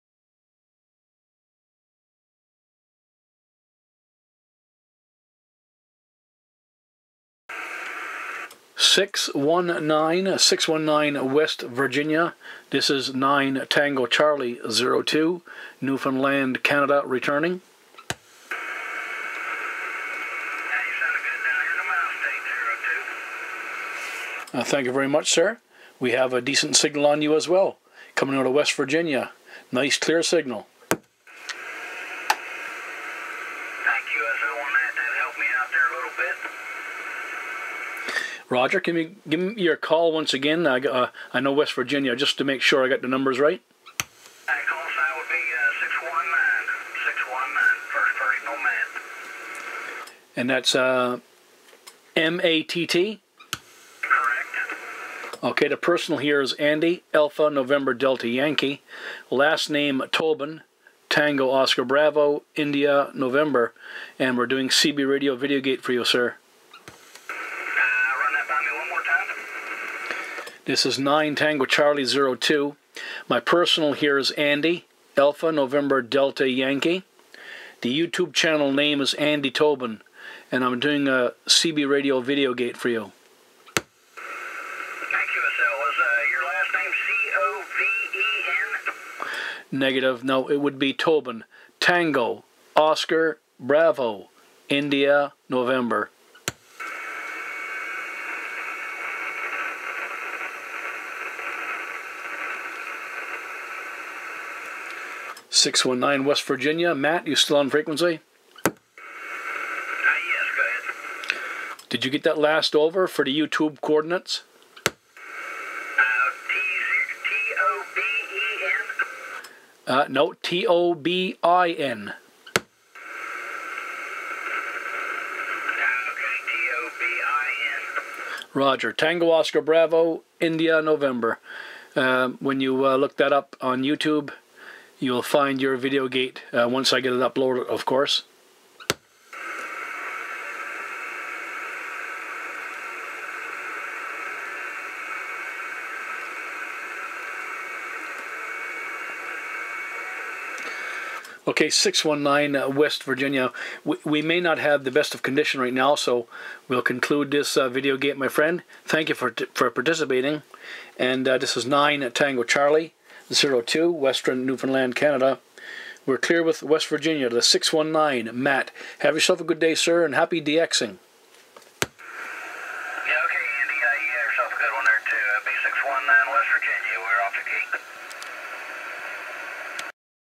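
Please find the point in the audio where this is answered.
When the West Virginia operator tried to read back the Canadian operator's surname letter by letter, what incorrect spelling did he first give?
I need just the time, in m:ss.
1:59.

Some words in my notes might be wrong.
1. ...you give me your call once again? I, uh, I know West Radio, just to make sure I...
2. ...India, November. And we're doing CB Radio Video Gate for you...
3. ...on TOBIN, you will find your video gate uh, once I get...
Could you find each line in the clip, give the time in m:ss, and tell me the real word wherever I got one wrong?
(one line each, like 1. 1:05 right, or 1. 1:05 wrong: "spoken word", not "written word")
1. 0:38 wrong: "Virginia", not "Radio"
2. 1:02 right
3. 2:13 wrong: "YouTube", not "TOBIN".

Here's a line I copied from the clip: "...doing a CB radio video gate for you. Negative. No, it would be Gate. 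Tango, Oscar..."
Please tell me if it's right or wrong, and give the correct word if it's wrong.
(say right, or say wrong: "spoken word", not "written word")
wrong: "Tobin", not "Gate".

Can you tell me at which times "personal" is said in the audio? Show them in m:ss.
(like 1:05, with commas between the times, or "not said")
0:55, 1:13.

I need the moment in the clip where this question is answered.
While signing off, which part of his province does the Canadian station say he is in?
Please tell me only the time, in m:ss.
2:43.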